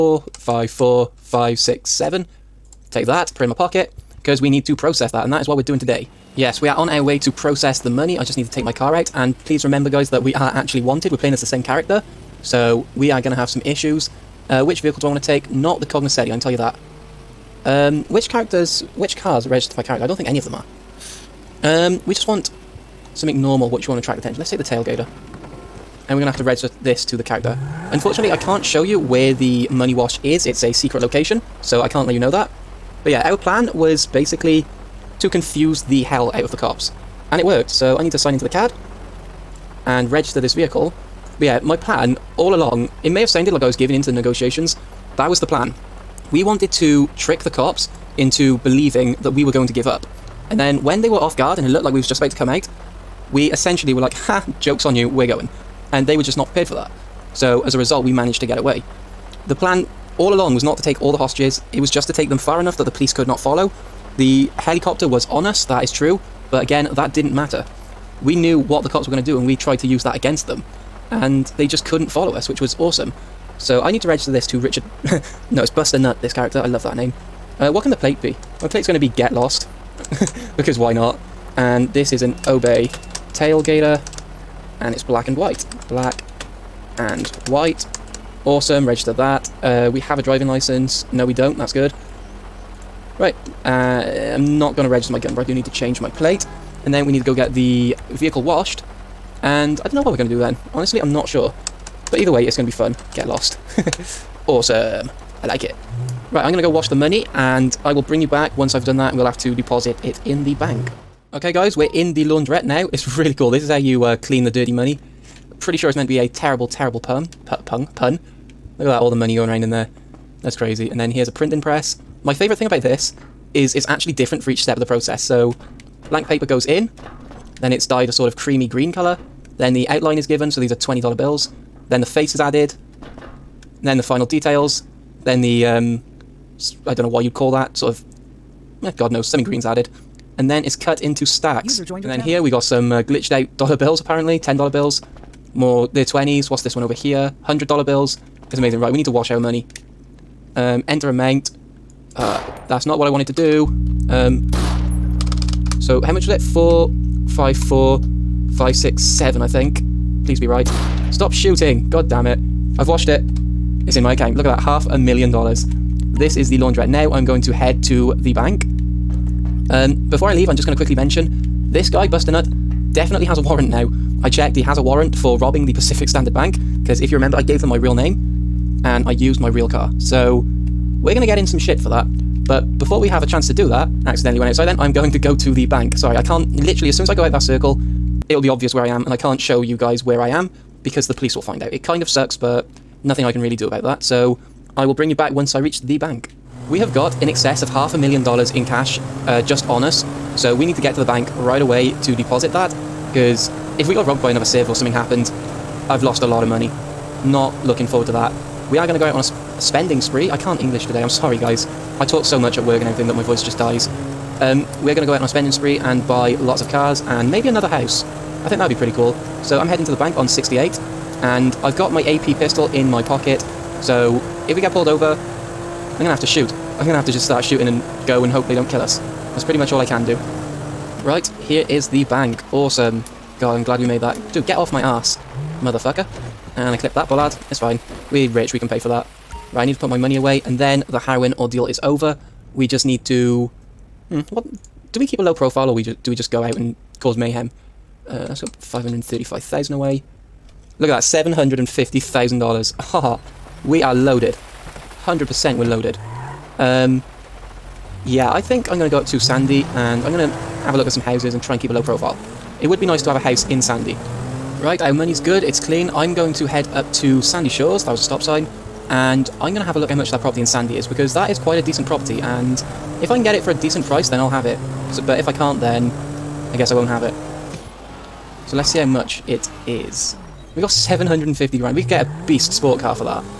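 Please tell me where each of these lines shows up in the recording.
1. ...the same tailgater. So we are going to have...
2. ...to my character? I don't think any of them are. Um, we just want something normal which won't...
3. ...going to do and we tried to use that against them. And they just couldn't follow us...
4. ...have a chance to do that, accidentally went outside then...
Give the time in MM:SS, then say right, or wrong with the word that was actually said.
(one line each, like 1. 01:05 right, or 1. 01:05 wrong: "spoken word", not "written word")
1. 00:11 wrong: "character", not "tailgater"
2. 00:19 right
3. 01:09 right
4. 03:03 right.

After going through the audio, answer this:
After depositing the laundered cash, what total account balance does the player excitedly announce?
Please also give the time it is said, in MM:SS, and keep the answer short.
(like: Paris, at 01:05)
$750,000, at 04:11.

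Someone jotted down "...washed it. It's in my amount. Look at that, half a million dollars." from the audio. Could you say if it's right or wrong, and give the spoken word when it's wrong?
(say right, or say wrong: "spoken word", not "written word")
wrong: "account", not "amount".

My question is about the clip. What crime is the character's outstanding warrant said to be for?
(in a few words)
Robbing the Pacific Standard Bank.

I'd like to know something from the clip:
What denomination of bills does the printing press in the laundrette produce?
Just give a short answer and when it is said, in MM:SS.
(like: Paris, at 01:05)
$20, at 02:10.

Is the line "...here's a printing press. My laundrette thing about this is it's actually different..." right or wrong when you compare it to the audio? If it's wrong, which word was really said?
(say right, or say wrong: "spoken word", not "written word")
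wrong: "favorite", not "laundrette".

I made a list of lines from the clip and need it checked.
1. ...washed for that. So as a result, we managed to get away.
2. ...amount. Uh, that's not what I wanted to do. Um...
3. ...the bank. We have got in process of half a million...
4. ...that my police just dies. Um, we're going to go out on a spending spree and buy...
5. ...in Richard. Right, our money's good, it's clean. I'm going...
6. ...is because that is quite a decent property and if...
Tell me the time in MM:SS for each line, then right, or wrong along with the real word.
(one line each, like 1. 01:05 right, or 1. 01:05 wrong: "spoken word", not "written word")
1. 00:56 wrong: "prepared", not "washed"
2. 02:31 right
3. 03:15 wrong: "excess", not "process"
4. 03:33 wrong: "voice", not "police"
5. 04:23 wrong: "Sandy", not "Richard"
6. 04:30 right.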